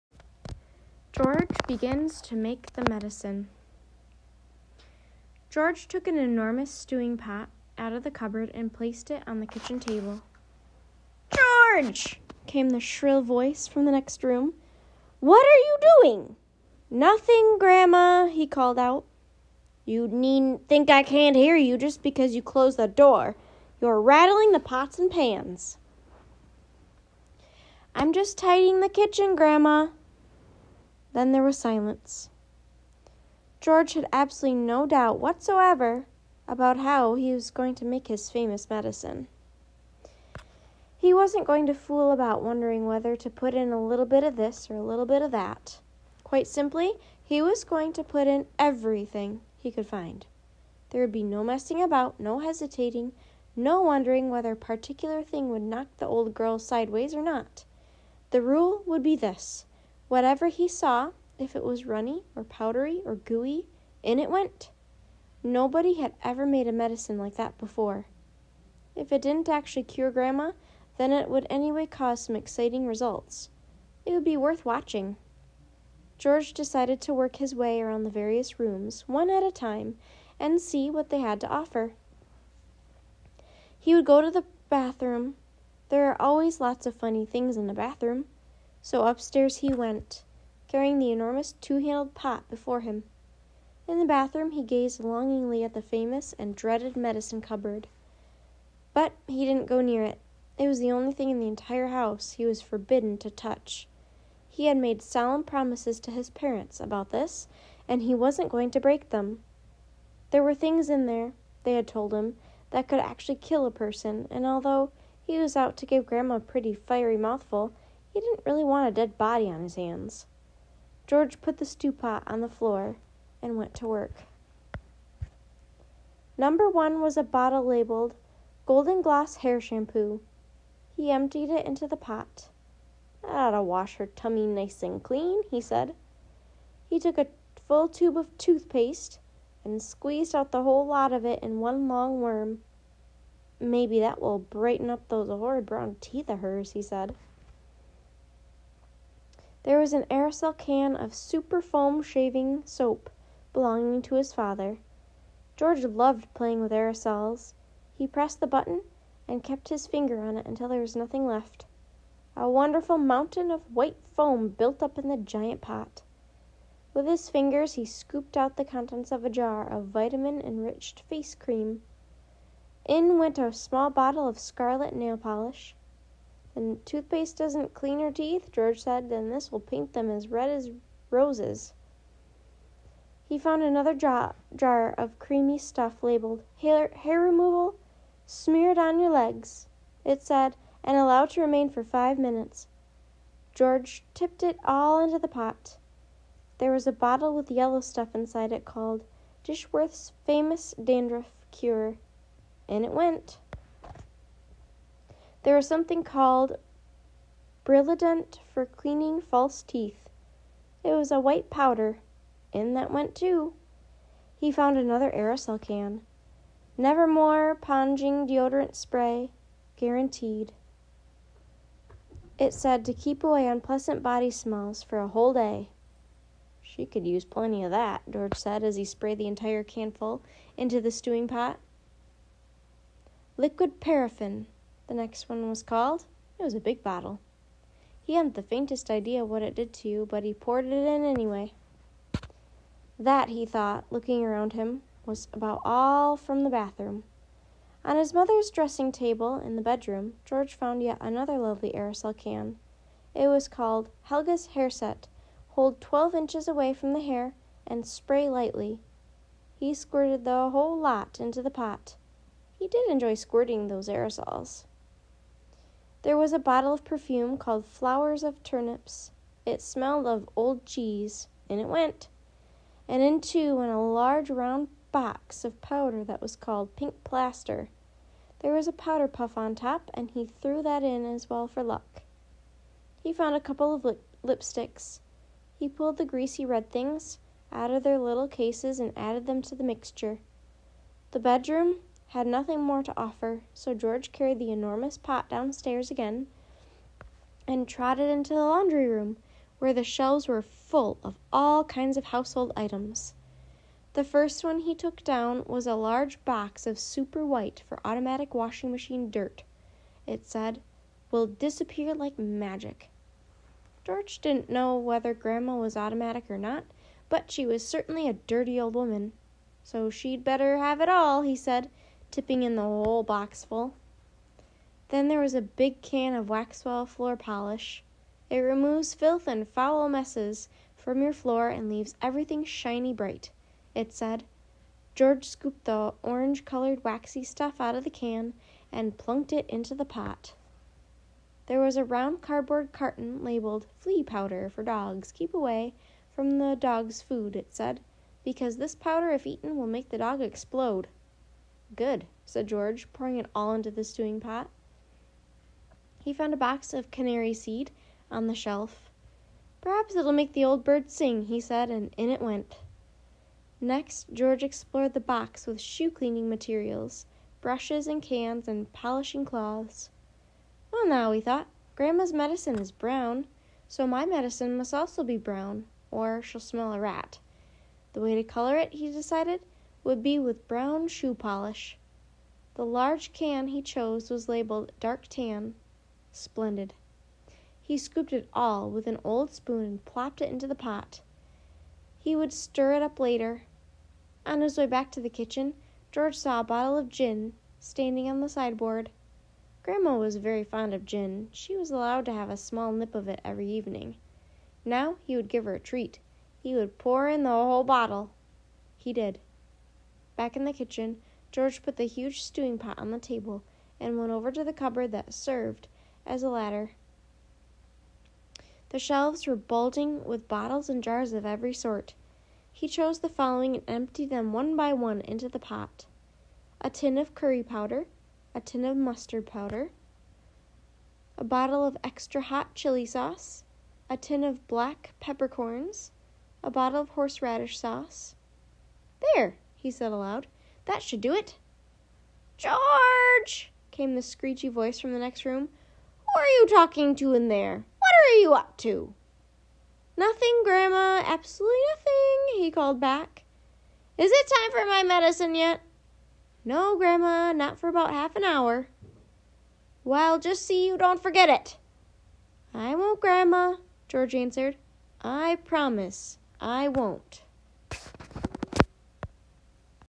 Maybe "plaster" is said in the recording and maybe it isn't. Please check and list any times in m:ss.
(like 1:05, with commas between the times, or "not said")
4:37.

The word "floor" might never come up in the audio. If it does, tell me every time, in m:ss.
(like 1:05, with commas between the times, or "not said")
2:02, 5:26, 5:31.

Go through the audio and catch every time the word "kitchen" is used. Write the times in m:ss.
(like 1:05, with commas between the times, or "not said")
0:09, 0:28, 6:35, 6:50.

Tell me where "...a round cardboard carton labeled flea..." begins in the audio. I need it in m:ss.
5:41.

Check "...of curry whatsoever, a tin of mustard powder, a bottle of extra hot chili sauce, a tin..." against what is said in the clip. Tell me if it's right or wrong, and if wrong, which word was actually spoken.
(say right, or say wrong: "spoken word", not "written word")
wrong: "powder", not "whatsoever".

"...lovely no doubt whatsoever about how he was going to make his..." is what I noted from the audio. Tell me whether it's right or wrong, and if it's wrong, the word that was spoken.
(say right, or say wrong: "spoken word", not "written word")
wrong: "absolutely", not "lovely".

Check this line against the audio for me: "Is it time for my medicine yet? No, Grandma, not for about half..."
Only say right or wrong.
right.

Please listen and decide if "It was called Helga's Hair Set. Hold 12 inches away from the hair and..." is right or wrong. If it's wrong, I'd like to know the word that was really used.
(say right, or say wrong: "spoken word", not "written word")
right.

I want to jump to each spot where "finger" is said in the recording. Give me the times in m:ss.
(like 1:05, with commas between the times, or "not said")
2:39, 2:47.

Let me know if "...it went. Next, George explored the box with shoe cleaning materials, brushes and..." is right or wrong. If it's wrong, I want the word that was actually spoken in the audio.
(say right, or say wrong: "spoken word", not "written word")
right.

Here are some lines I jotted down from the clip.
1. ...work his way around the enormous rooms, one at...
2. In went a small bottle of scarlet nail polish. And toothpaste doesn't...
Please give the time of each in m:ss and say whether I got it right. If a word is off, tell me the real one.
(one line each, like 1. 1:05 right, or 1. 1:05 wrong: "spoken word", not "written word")
1. 1:17 wrong: "various", not "enormous"
2. 2:52 right.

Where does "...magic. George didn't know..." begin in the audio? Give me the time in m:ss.
5:12.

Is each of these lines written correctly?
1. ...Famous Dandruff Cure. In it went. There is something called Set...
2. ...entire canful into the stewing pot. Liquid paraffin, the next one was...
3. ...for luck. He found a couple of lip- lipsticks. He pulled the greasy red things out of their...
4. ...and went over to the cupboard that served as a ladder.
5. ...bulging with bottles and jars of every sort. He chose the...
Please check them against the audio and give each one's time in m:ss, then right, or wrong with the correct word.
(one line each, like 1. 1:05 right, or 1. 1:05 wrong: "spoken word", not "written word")
1. 3:20 wrong: "Brillident", not "Set"
2. 3:49 right
3. 4:41 right
4. 6:53 right
5. 6:59 right.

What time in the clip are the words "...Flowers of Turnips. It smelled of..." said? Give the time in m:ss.
4:27.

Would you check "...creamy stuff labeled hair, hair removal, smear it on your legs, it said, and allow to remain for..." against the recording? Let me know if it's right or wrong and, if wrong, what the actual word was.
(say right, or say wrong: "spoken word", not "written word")
right.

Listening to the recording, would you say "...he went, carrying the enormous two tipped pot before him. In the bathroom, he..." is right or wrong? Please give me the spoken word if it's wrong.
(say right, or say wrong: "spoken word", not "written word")
wrong: "handled", not "tipped".